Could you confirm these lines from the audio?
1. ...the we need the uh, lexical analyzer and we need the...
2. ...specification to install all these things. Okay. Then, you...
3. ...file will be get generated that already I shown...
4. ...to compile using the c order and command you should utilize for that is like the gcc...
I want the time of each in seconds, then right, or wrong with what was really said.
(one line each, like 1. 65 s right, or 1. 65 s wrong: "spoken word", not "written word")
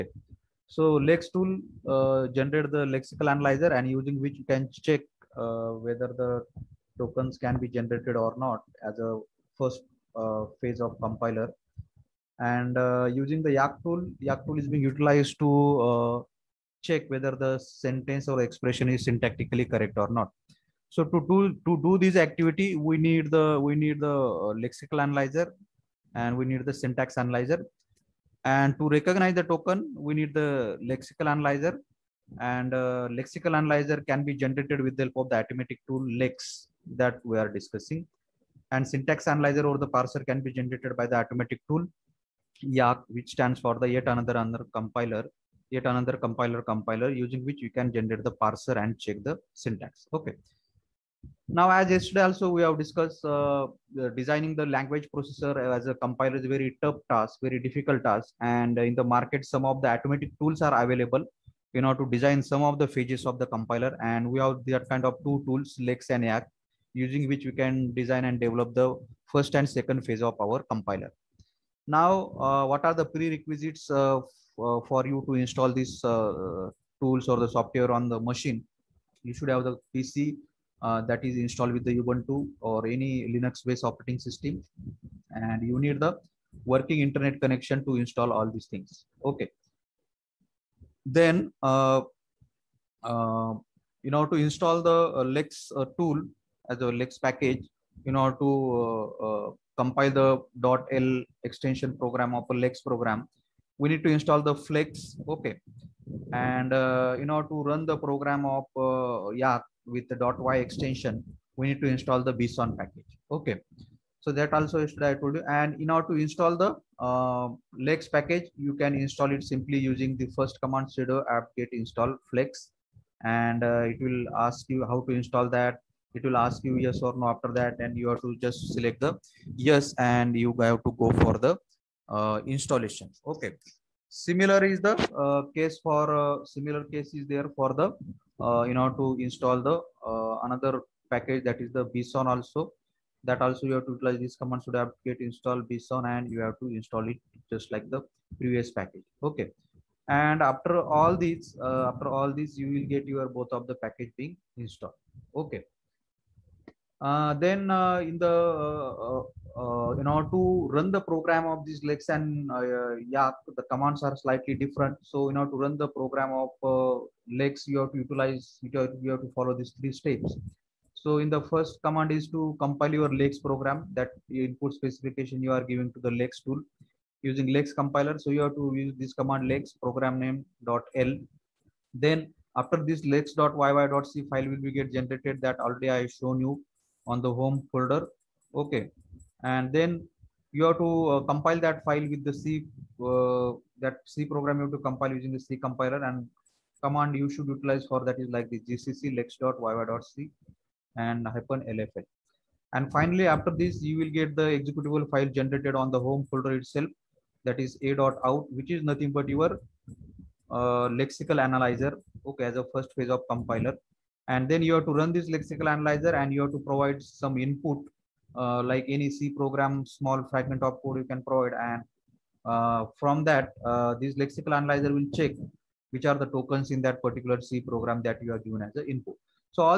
1. 23 s right
2. 87 s wrong: "connection", not "specification"
3. 184 s right
4. 194 s wrong: "compiler", not "order".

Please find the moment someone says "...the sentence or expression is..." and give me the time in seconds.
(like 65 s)
17 s.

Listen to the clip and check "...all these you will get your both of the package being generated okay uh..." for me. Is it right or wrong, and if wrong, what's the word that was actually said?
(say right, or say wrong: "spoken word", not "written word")
wrong: "installed", not "generated".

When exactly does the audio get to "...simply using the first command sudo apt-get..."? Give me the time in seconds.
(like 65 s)
119 s.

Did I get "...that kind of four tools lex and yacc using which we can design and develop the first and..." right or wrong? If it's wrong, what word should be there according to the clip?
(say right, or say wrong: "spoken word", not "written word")
wrong: "two", not "four".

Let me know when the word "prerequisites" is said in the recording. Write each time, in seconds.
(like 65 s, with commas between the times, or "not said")
73 s.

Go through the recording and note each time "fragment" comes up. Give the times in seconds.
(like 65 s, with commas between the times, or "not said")
220 s.